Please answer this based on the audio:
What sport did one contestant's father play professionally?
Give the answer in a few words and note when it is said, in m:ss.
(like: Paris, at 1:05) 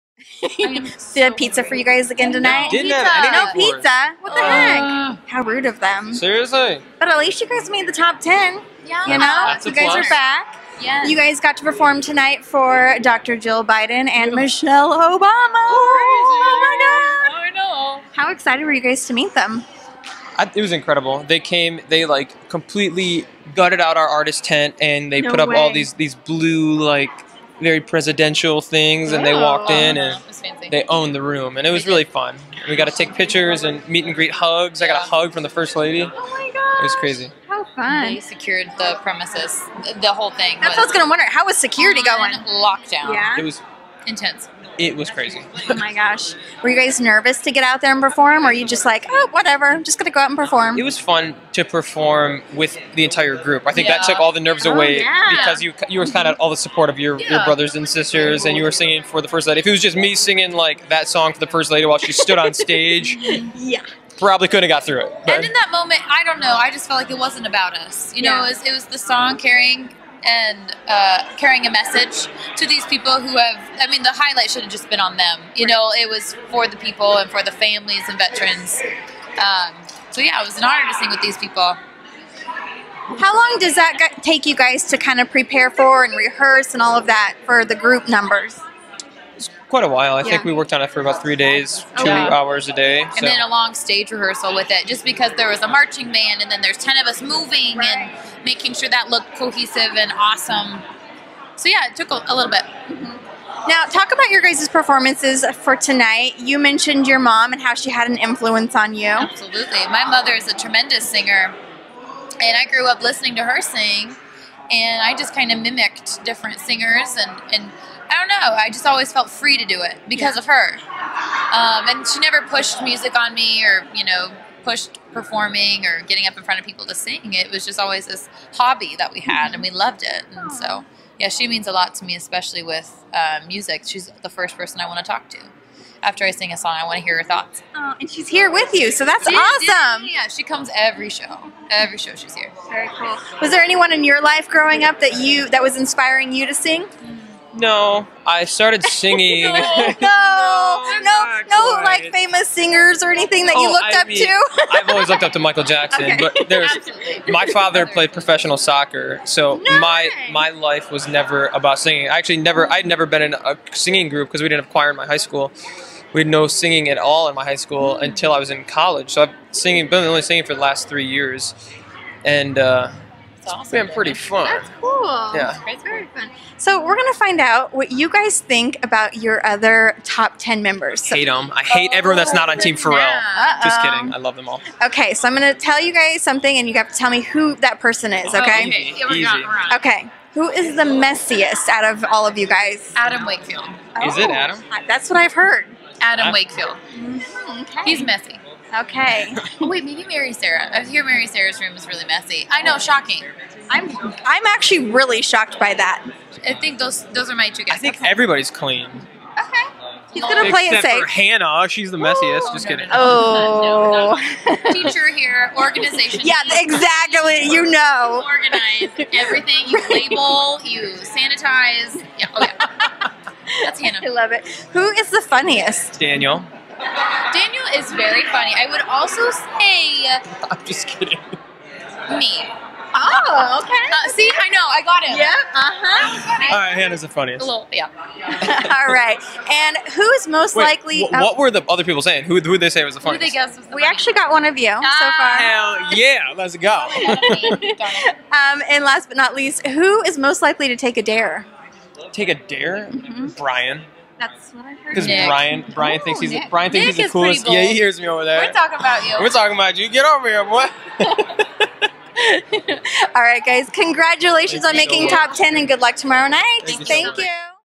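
Soccer, at 2:38.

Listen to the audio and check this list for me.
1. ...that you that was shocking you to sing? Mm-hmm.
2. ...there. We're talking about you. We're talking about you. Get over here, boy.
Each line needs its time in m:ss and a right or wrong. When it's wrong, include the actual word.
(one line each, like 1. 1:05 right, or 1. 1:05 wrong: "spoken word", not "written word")
1. 2:25 wrong: "inspiring", not "shocking"
2. 4:18 right.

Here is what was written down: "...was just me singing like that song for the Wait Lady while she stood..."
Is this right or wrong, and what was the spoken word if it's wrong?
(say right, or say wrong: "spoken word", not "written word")
wrong: "First", not "Wait".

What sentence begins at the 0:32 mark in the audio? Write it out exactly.
we got to take pictures and meet and greet hugs.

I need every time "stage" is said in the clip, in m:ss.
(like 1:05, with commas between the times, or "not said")
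1:02, 1:33.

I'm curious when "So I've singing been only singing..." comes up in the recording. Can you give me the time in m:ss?
2:49.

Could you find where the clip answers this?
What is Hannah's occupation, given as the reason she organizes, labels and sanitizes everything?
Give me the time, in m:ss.
3:34.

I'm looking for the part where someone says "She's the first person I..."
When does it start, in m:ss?
2:13.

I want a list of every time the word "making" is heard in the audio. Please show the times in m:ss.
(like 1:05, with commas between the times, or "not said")
1:38, 4:24.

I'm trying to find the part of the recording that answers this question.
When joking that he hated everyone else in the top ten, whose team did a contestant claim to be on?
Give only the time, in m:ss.
3:02.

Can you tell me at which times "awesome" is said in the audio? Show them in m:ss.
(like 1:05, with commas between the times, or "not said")
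1:40, 2:19, 2:53.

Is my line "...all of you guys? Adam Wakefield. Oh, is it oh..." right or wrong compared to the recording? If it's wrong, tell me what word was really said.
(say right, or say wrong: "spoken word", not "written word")
right.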